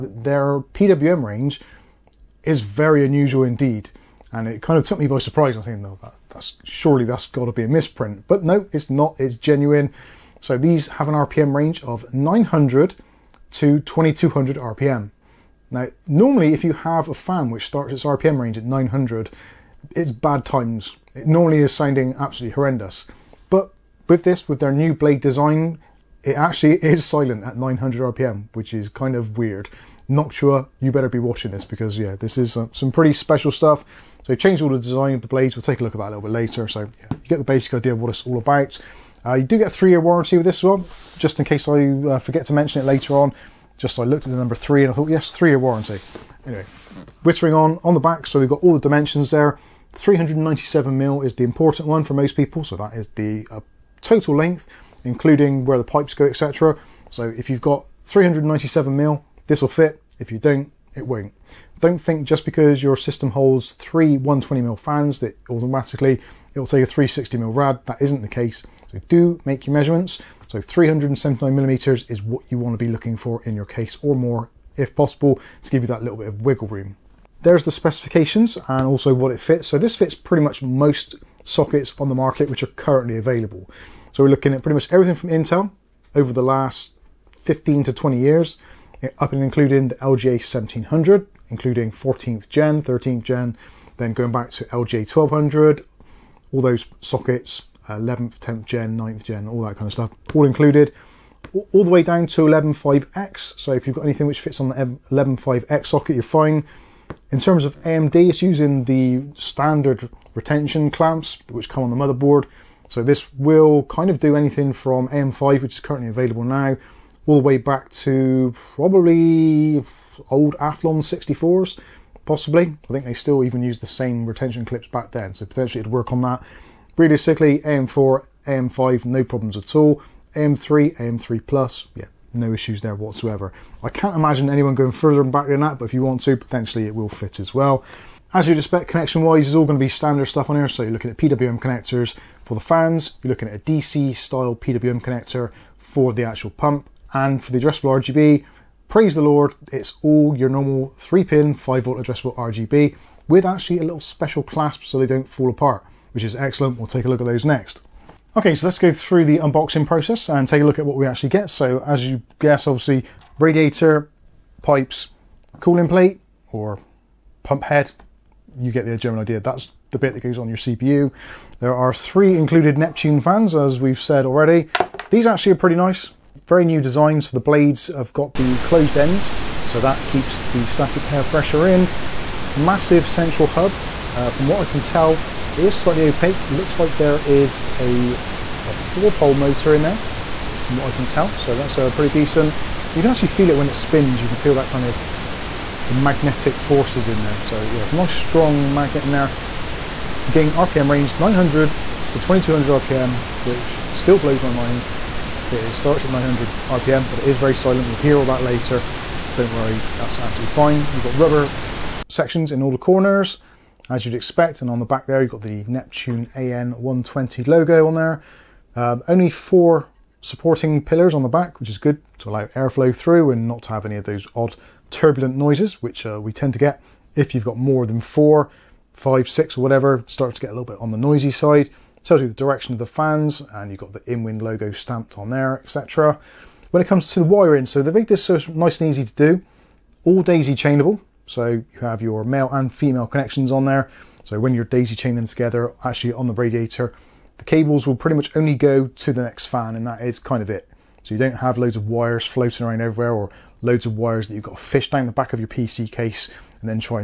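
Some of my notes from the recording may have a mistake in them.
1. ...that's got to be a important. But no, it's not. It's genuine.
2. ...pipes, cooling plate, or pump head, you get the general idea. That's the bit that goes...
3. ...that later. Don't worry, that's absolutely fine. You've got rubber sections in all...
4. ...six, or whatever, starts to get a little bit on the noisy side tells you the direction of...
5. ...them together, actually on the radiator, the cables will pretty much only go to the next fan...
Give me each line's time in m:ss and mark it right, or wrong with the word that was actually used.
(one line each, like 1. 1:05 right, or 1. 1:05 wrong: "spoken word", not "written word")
1. 0:07 wrong: "misprint", not "important"
2. 2:44 right
3. 3:28 right
4. 3:49 right
5. 4:05 right.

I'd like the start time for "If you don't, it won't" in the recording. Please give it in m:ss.
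1:00.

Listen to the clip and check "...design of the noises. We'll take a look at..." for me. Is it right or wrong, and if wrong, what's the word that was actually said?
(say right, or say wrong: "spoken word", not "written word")
wrong: "blades", not "noises".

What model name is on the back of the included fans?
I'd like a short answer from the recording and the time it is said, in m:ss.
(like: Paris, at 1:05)
Neptune AN120, at 3:35.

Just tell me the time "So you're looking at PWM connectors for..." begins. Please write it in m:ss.
2:20.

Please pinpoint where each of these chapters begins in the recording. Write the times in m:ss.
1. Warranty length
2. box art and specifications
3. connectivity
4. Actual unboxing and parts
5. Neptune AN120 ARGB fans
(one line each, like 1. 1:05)
1. 0:36
2. 0:48
3. 2:19
4. 2:38
5. 2:52.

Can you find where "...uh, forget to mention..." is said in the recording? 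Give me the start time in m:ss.
0:41.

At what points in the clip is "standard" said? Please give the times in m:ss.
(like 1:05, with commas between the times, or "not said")
1:49, 2:19.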